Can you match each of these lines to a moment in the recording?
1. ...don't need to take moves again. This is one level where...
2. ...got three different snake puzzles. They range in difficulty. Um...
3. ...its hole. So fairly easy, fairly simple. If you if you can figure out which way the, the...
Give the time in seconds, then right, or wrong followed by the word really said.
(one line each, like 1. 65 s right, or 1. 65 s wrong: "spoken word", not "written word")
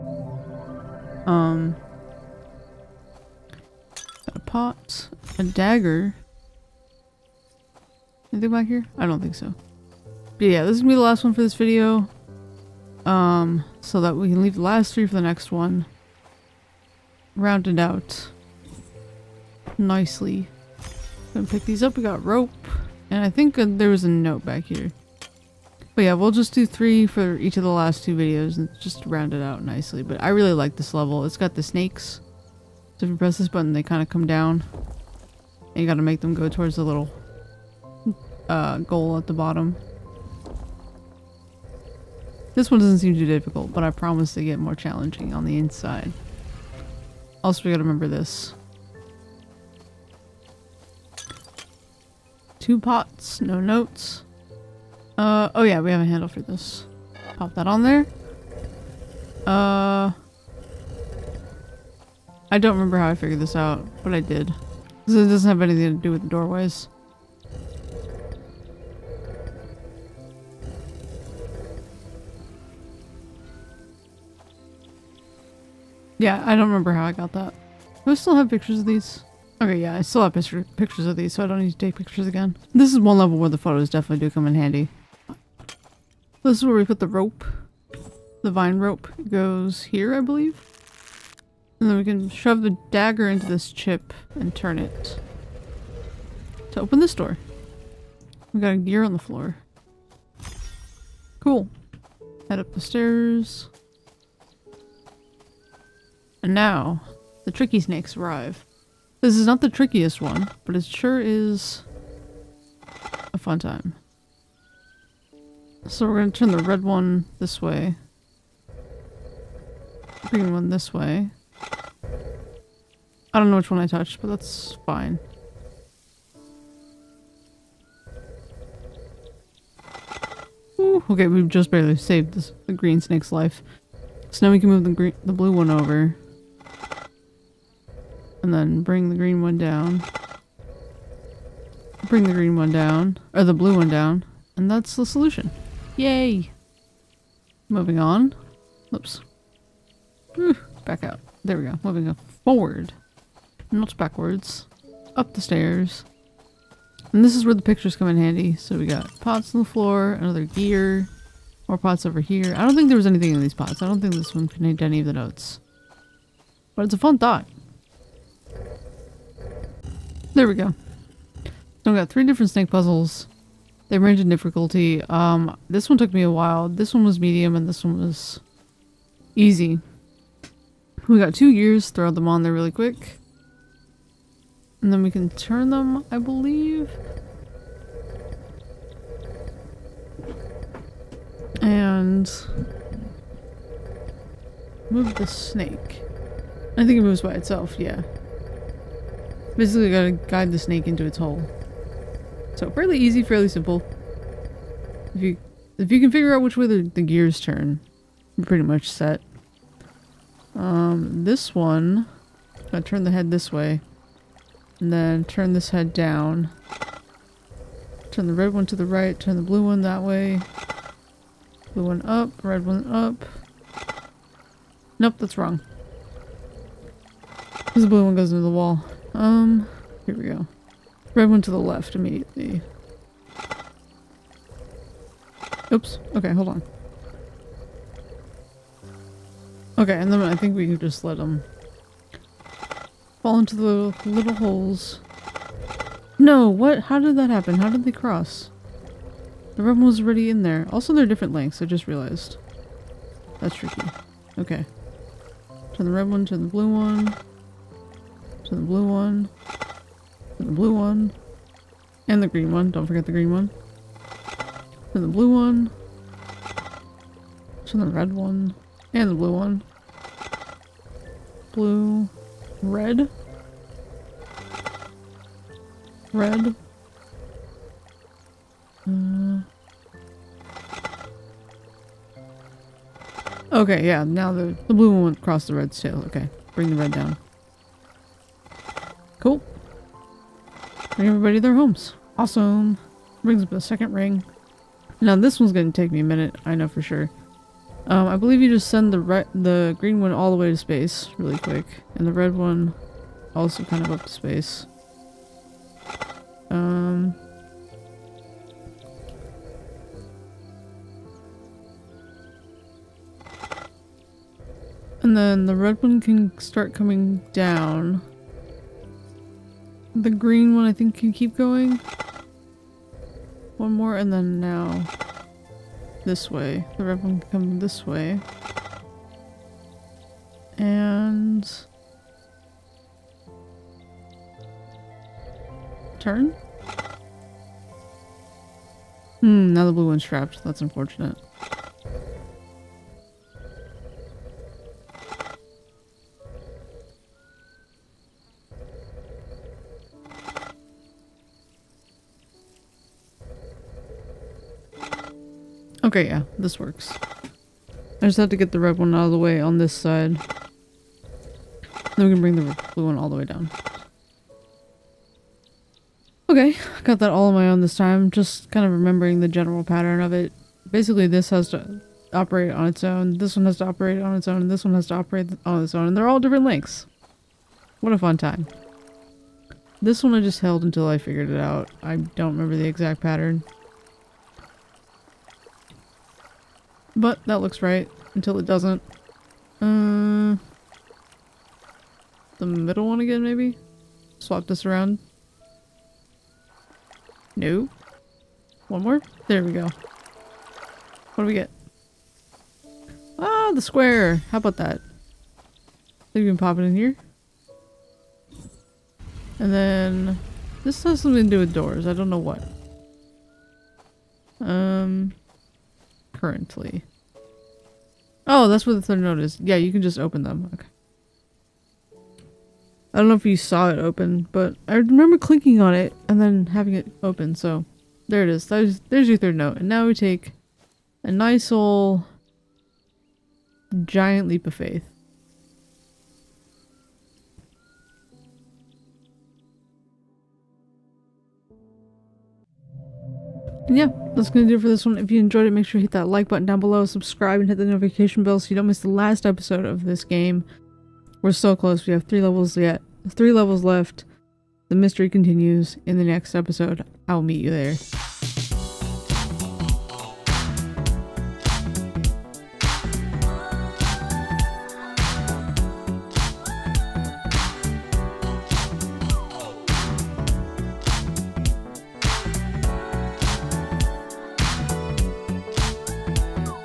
1. 81 s wrong: "pictures", not "moves"
2. 171 s right
3. 201 s right.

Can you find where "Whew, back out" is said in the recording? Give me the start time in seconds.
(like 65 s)
150 s.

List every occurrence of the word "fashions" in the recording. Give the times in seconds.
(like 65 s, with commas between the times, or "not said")
not said.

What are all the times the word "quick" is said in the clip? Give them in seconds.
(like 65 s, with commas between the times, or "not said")
182 s, 301 s.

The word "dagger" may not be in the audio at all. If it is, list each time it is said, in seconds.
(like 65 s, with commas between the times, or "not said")
5 s, 92 s.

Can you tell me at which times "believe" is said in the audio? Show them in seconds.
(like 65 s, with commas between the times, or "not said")
90 s, 186 s, 298 s.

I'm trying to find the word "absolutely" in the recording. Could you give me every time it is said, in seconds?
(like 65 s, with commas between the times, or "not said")
not said.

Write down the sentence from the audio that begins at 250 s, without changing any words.
Also, they're different lengths, I just realized.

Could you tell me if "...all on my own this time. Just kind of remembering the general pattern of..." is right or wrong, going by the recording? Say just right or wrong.
right.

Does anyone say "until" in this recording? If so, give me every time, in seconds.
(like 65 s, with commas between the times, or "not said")
380 s, 388 s.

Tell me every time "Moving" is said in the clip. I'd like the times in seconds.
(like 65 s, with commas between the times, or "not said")
147 s, 151 s.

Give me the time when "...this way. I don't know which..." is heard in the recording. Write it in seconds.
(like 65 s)
120 s.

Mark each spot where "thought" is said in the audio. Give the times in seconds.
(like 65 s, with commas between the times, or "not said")
167 s.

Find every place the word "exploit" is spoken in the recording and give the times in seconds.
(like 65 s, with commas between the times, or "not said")
not said.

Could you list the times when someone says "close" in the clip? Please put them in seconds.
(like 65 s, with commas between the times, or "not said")
451 s.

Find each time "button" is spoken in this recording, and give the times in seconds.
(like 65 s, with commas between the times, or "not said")
33 s, 446 s.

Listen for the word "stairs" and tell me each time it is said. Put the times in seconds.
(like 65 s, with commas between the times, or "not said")
102 s, 155 s.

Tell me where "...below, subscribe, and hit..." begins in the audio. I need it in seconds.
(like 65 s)
446 s.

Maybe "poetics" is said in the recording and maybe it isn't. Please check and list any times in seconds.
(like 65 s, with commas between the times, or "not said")
not said.